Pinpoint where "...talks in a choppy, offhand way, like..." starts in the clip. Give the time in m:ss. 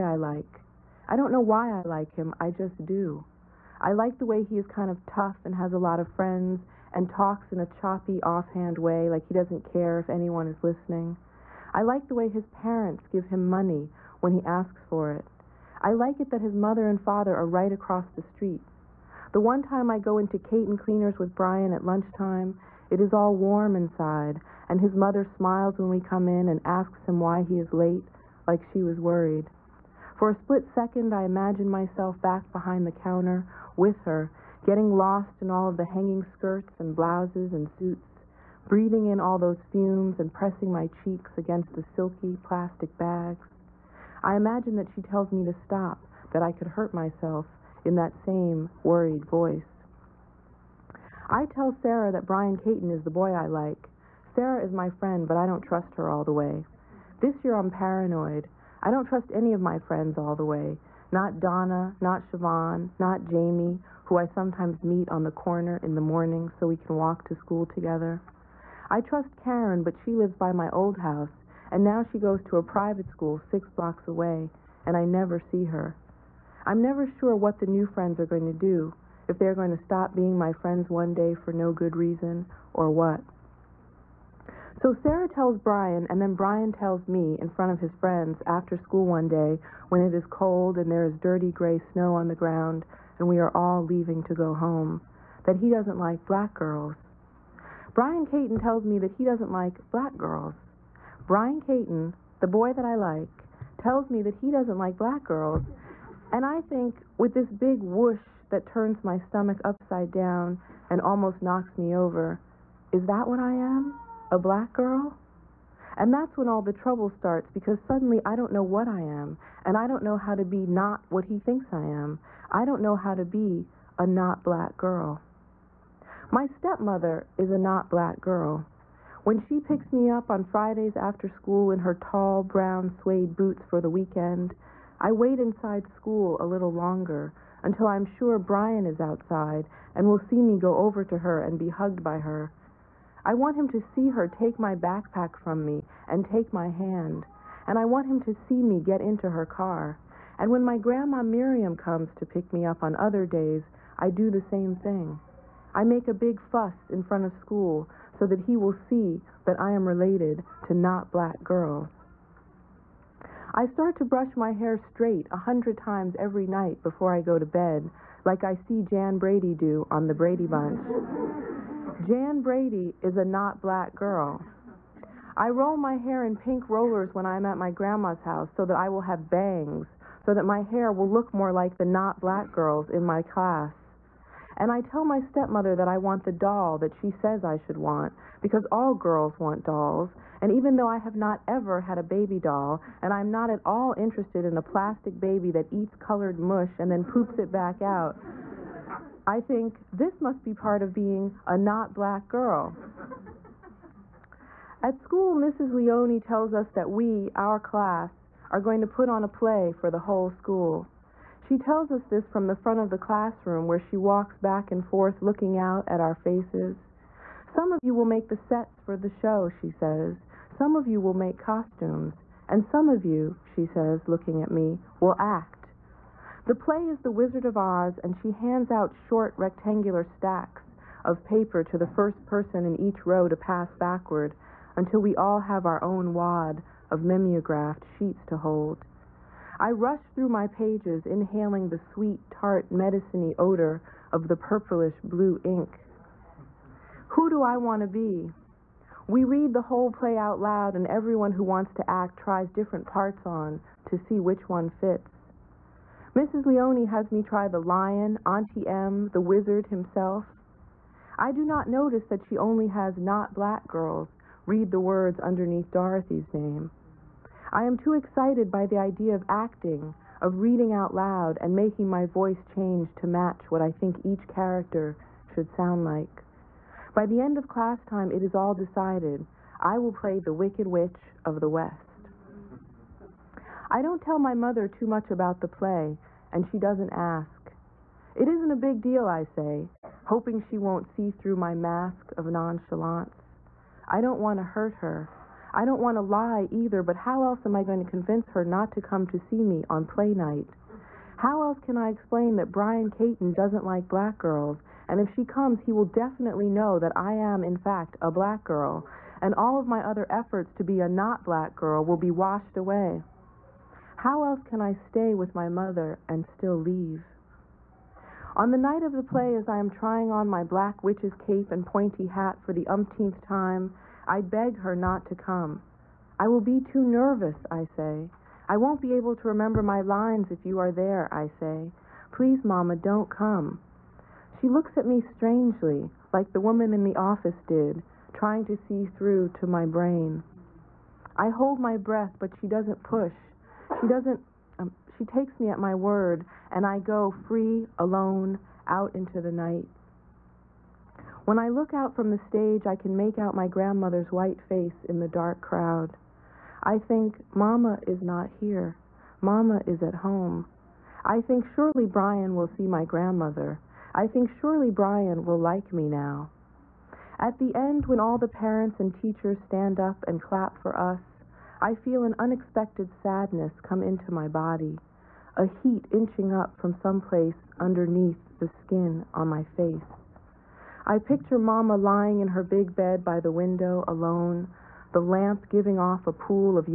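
0:07.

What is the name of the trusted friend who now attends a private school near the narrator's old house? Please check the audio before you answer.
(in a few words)
Karen.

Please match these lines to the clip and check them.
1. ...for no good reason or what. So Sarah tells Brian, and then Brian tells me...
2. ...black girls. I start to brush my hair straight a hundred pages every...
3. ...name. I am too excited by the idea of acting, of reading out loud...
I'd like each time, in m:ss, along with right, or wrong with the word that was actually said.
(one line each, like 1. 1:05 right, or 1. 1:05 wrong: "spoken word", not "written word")
1. 1:21 right
2. 2:41 wrong: "times", not "pages"
3. 4:26 right.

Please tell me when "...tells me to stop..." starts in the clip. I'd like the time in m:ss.
0:45.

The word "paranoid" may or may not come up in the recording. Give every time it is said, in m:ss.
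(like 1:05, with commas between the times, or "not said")
0:57.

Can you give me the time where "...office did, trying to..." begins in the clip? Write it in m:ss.
5:36.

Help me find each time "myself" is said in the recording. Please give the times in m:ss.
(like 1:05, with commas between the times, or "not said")
0:31, 0:46.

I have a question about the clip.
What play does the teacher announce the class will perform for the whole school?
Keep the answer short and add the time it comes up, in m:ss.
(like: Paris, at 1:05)
The Wizard of Oz, at 3:47.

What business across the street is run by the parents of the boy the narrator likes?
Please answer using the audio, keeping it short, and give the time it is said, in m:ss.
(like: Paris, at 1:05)
Kate and Cleaners, at 0:20.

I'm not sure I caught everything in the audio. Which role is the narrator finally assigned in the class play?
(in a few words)
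Wicked Witch of the West.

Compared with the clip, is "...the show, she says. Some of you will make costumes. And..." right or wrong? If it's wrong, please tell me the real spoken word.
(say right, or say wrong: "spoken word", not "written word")
right.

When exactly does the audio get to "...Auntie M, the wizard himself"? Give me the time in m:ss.
4:18.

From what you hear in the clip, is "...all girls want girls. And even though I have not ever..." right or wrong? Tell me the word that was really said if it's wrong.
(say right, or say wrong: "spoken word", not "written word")
wrong: "dolls", not "girls".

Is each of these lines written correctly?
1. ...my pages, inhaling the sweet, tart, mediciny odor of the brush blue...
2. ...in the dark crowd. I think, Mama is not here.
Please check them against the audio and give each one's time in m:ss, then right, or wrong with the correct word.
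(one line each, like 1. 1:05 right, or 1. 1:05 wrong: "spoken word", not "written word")
1. 4:00 wrong: "purplish", not "brush"
2. 5:54 right.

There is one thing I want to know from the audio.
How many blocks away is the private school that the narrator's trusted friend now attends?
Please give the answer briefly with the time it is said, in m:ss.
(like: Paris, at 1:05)
6, at 1:13.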